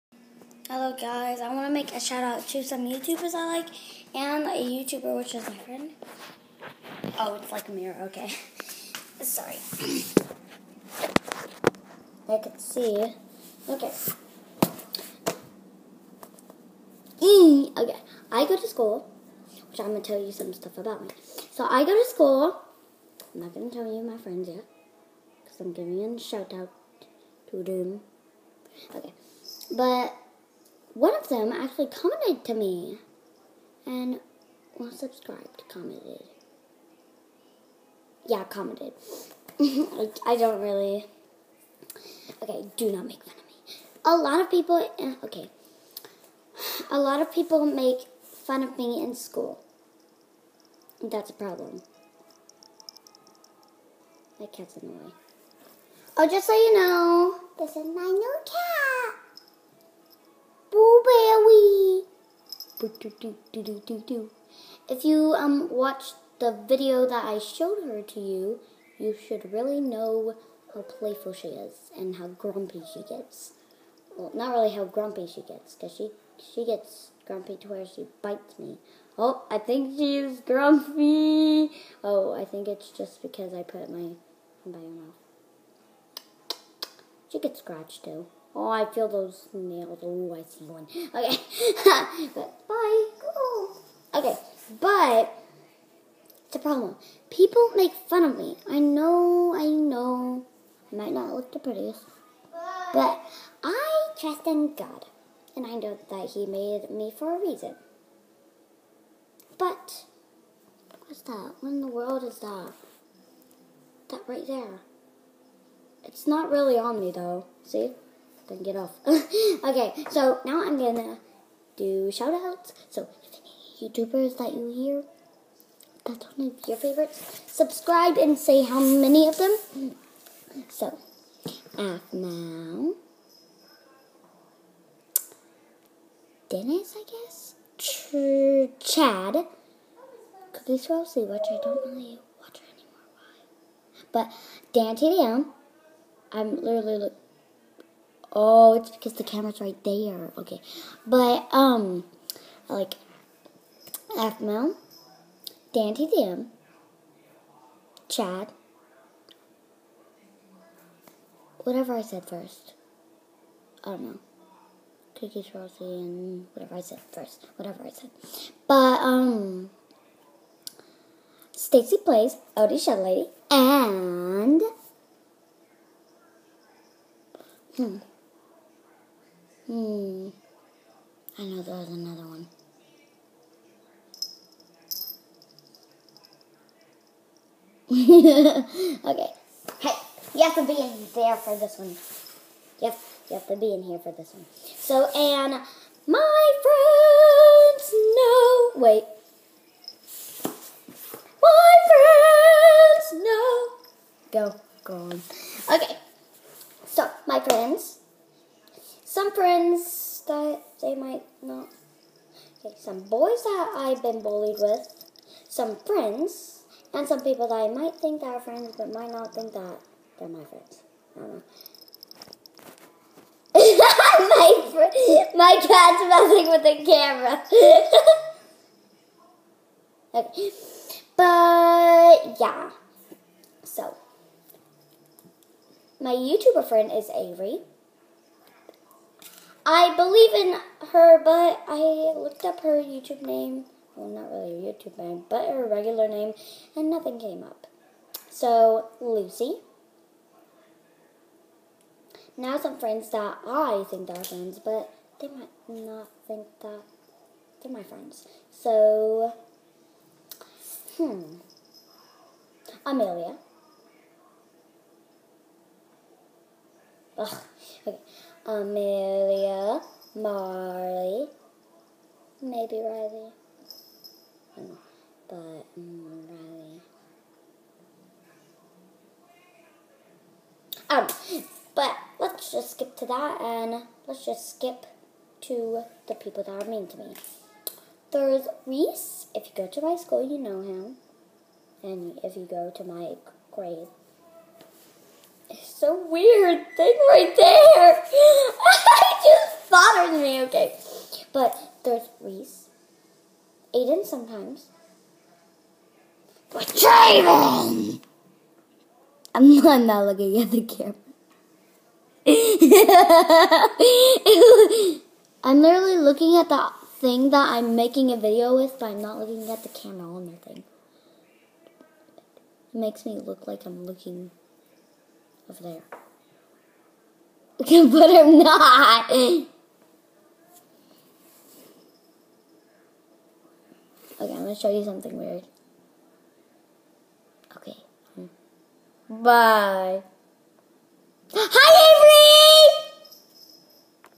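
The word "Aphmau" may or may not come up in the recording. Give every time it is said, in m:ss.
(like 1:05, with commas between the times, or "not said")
2:11, 2:34.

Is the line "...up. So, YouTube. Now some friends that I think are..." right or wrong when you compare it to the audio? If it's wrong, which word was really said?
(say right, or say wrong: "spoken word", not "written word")
wrong: "Lucy", not "YouTube".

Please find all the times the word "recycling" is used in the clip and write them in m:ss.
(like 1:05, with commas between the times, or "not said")
not said.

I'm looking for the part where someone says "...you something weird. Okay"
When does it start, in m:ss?
5:34.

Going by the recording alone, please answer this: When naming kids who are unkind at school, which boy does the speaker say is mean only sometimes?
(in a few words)
Aiden.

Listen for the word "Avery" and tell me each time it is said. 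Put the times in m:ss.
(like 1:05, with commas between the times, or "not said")
3:57, 5:42.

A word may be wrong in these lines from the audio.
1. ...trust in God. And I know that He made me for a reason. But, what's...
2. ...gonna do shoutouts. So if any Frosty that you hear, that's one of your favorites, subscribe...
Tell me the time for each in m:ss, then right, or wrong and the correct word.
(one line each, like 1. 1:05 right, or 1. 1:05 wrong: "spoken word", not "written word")
1. 1:44 right
2. 2:00 wrong: "YouTubers", not "Frosty".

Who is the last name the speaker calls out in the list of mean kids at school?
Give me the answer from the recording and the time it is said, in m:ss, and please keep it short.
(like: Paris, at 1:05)
Draven, at 5:06.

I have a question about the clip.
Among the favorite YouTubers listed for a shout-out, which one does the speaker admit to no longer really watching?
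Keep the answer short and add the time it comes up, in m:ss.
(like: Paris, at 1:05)
CookieSwirlC, at 2:20.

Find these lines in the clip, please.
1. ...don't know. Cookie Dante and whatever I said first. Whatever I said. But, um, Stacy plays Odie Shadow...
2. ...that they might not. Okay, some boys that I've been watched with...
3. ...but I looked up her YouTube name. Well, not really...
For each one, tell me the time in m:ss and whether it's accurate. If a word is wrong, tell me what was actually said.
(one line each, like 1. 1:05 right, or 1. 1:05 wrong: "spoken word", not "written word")
1. 2:43 wrong: "Frosty", not "Dante"
2. 3:30 wrong: "bullied", not "watched"
3. 4:01 right.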